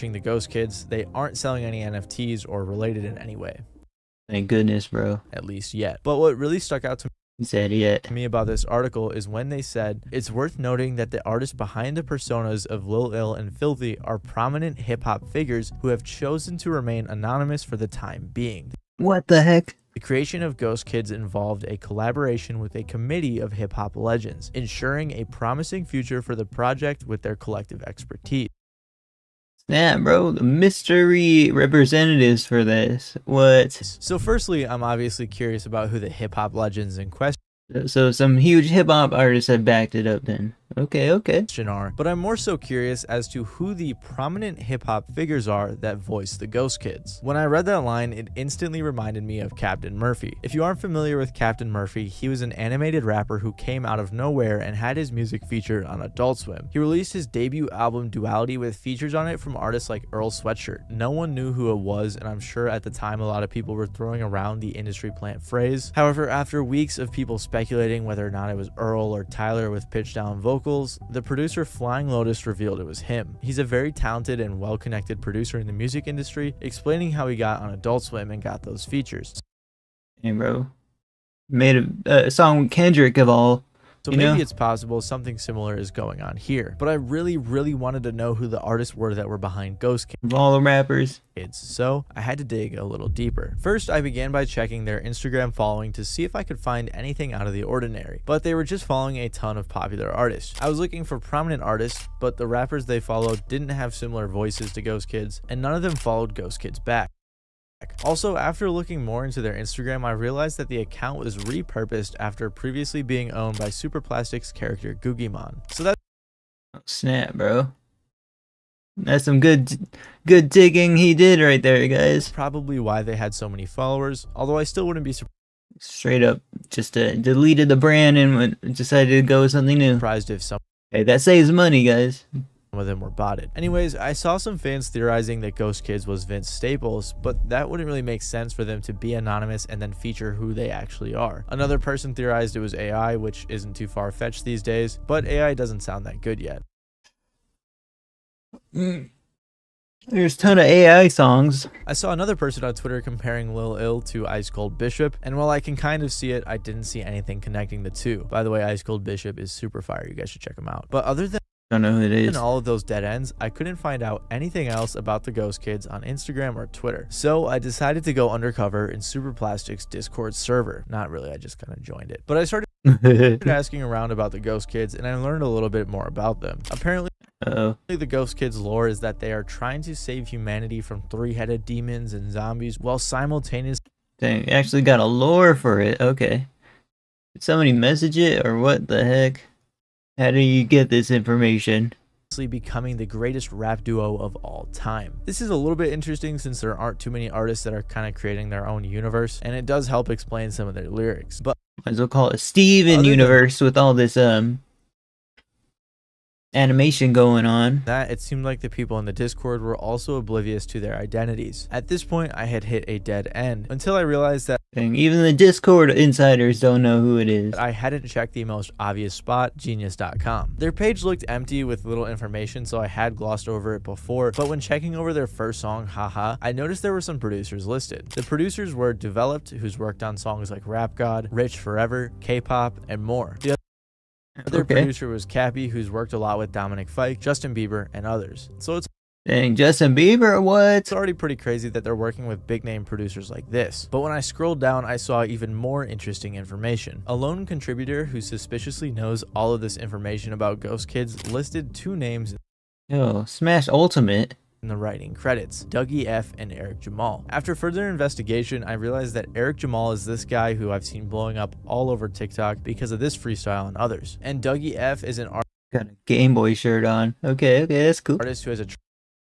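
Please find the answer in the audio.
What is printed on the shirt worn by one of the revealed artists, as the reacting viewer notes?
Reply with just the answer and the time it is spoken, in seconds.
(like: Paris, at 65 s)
Game Boy, at 266 s.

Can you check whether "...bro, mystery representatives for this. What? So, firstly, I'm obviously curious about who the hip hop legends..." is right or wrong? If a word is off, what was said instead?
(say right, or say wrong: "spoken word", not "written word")
right.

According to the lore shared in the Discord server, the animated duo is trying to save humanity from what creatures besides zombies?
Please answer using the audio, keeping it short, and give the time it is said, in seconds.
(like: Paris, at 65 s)
three-headed demons, at 181 s.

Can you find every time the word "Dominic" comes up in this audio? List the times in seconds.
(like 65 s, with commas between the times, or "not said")
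236 s.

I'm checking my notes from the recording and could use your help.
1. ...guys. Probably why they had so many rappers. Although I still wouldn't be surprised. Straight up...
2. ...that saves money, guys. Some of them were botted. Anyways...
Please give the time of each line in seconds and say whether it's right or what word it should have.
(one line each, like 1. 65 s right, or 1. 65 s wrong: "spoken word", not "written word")
1. 121 s wrong: "followers", not "rappers"
2. 131 s right.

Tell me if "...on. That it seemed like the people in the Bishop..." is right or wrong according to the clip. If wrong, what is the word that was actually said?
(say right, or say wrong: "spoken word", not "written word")
wrong: "Discord", not "Bishop".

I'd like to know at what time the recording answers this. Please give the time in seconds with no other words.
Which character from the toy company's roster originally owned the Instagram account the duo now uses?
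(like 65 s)
114 s.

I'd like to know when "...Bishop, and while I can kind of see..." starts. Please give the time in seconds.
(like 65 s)
154 s.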